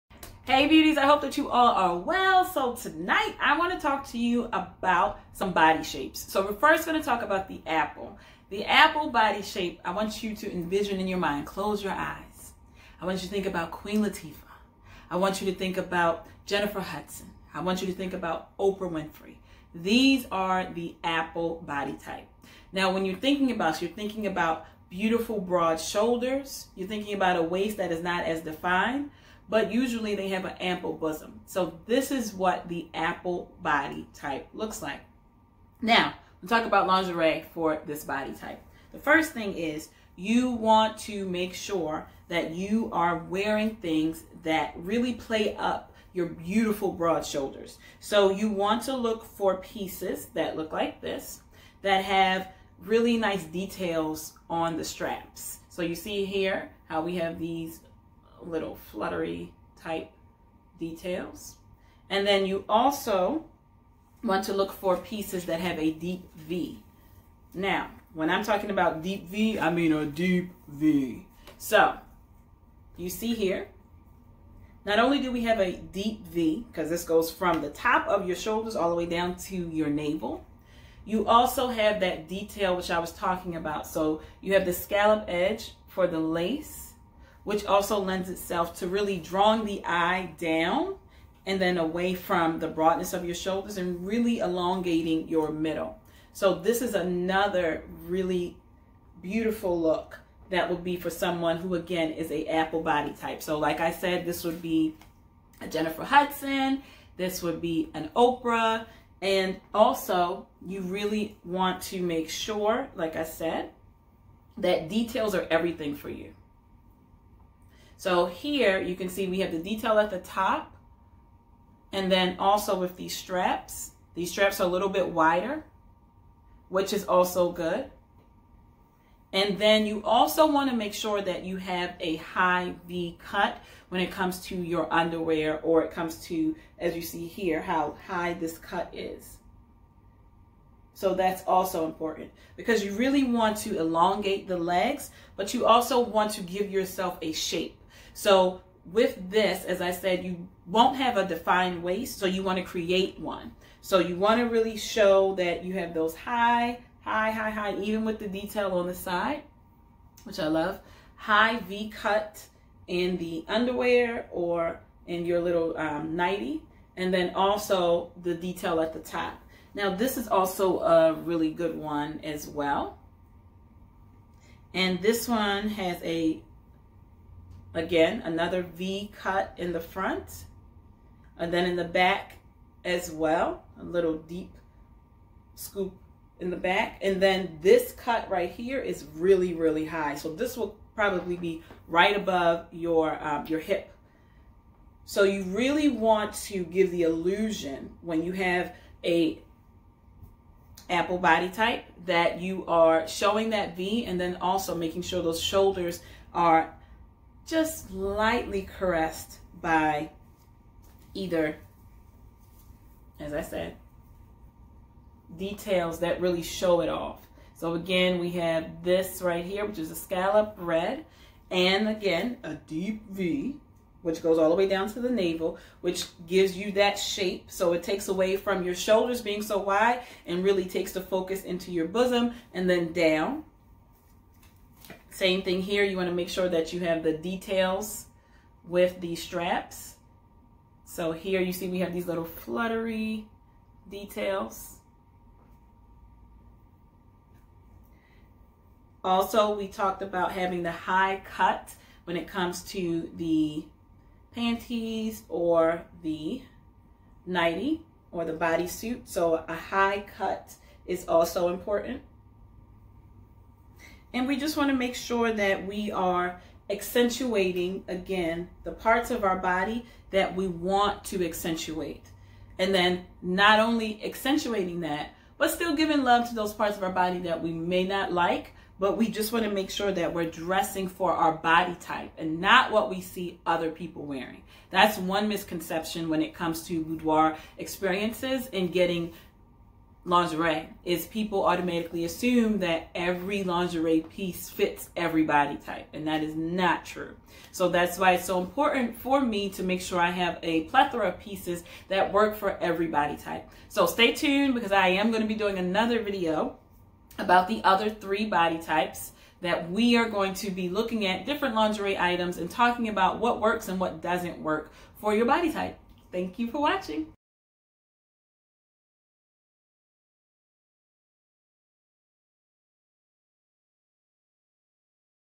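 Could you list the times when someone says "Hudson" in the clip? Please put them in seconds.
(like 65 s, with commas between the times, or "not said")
16 s, 106 s.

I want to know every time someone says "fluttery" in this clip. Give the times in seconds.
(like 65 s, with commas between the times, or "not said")
58 s, 242 s.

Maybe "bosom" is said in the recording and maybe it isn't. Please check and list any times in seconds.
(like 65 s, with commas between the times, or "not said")
30 s, 231 s.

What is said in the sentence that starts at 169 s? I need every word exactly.
Now this is also a really good one as well.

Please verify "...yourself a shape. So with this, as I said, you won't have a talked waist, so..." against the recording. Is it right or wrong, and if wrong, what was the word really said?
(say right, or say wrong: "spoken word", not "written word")
wrong: "defined", not "talked".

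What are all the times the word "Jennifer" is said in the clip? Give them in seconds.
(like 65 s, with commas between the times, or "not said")
16 s, 105 s.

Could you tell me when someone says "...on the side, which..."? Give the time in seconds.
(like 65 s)
158 s.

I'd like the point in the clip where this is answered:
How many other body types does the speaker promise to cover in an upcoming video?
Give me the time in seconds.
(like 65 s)
307 s.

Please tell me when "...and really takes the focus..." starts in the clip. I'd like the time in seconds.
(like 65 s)
230 s.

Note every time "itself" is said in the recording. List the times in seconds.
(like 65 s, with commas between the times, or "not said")
88 s.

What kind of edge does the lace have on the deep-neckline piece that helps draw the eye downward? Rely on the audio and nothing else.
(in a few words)
Scallop edge.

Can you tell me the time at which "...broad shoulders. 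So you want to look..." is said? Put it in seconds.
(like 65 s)
46 s.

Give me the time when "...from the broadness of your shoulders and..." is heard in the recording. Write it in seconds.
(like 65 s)
92 s.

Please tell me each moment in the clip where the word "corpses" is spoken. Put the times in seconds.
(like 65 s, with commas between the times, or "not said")
not said.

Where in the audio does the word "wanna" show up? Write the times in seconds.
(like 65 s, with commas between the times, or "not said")
235 s.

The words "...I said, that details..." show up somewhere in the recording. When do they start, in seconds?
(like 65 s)
113 s.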